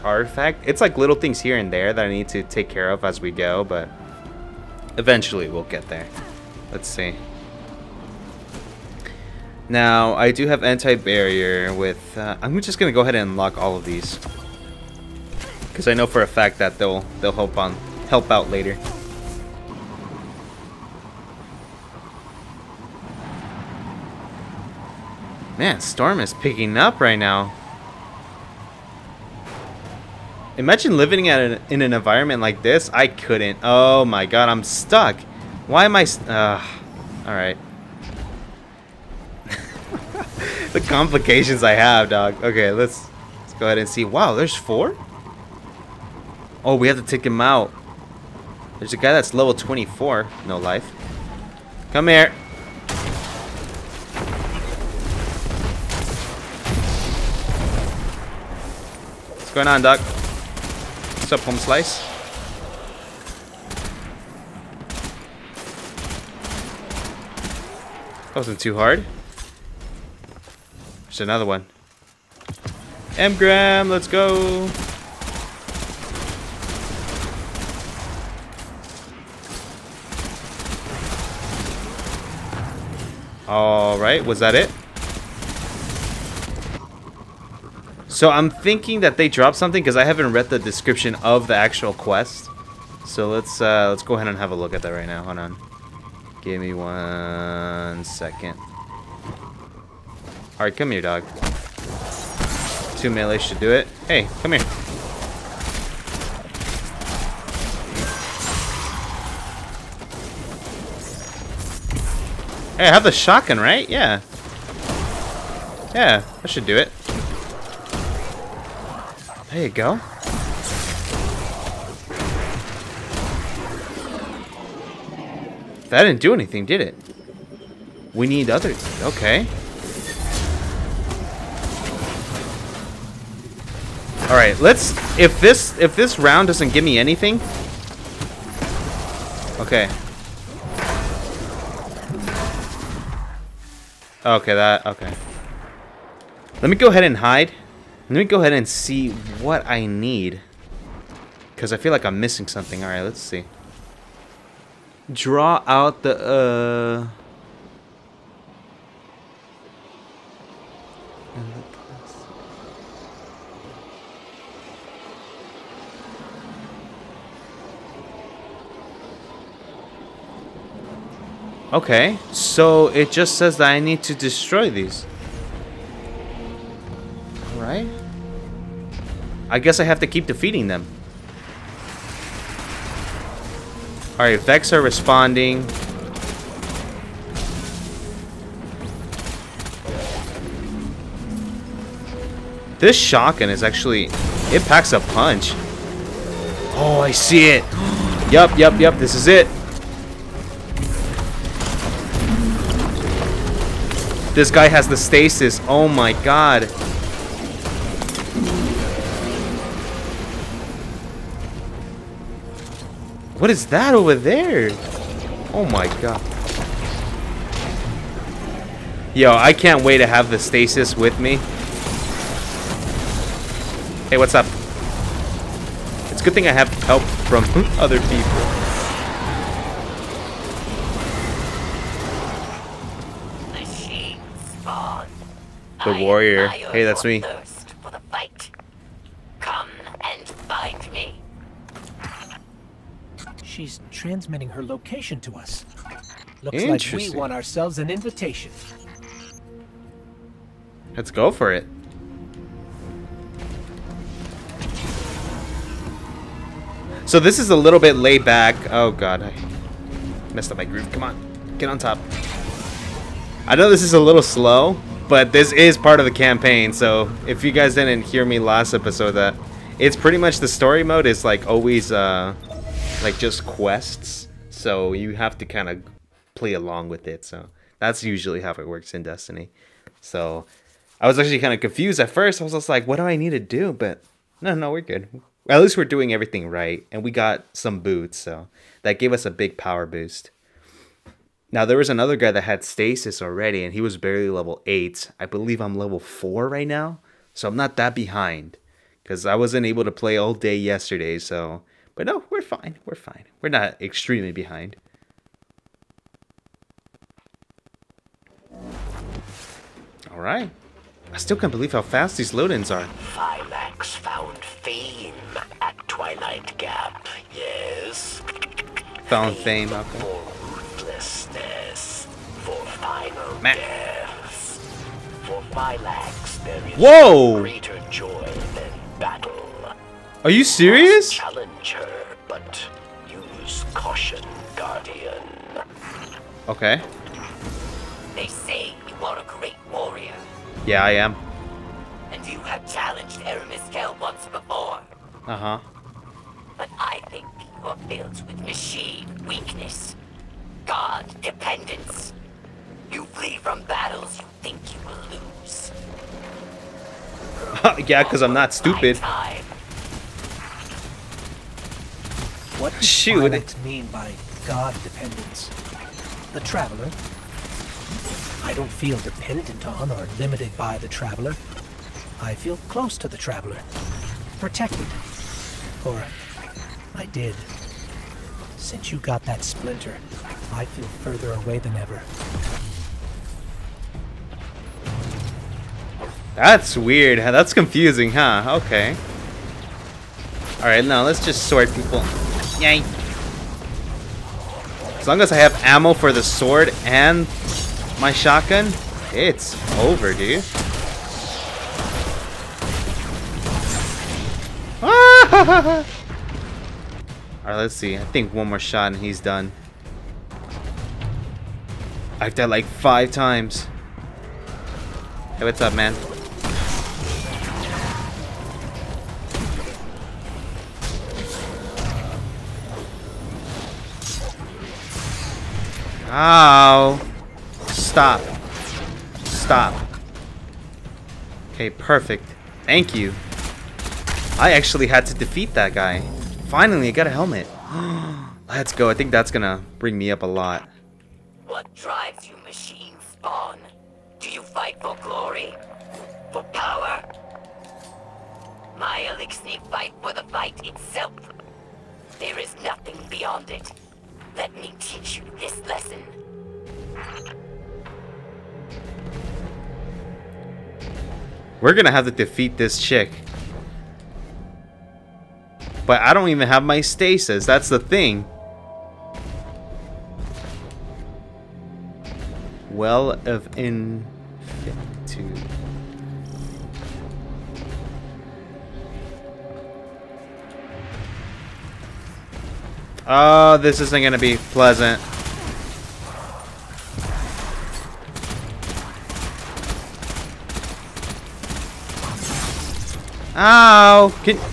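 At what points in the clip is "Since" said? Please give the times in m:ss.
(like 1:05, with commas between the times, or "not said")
6:18.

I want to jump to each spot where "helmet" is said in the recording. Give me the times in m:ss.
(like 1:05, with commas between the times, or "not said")
7:17.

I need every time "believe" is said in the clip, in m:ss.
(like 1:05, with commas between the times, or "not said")
4:55, 5:11.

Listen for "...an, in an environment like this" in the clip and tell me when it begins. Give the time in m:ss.
0:31.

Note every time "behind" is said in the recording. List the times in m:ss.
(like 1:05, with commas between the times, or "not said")
4:57, 5:04.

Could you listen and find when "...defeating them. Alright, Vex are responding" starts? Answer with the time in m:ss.
3:00.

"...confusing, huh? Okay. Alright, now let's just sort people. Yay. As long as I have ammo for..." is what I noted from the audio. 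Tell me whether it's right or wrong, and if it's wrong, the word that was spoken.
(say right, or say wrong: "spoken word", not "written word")
right.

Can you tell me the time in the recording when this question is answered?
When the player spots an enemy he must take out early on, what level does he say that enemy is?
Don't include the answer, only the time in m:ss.
0:49.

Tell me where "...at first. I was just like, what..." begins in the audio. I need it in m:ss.
4:41.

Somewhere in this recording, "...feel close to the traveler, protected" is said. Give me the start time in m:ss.
6:12.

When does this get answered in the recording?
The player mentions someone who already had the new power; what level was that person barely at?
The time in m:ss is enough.
4:54.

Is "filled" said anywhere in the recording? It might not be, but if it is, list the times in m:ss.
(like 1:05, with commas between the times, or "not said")
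5:47.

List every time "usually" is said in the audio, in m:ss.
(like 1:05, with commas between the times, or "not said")
4:38.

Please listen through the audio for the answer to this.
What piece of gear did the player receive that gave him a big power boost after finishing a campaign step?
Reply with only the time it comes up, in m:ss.
4:47.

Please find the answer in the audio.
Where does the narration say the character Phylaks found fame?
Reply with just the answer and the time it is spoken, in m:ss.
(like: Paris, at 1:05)
Twilight Gap, at 5:15.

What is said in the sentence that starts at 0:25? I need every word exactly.
Man, Storm is picking up right now.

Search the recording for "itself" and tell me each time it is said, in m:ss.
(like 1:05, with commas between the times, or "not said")
7:30.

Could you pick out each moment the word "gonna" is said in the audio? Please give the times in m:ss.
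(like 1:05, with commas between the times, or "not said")
7:19, 7:41.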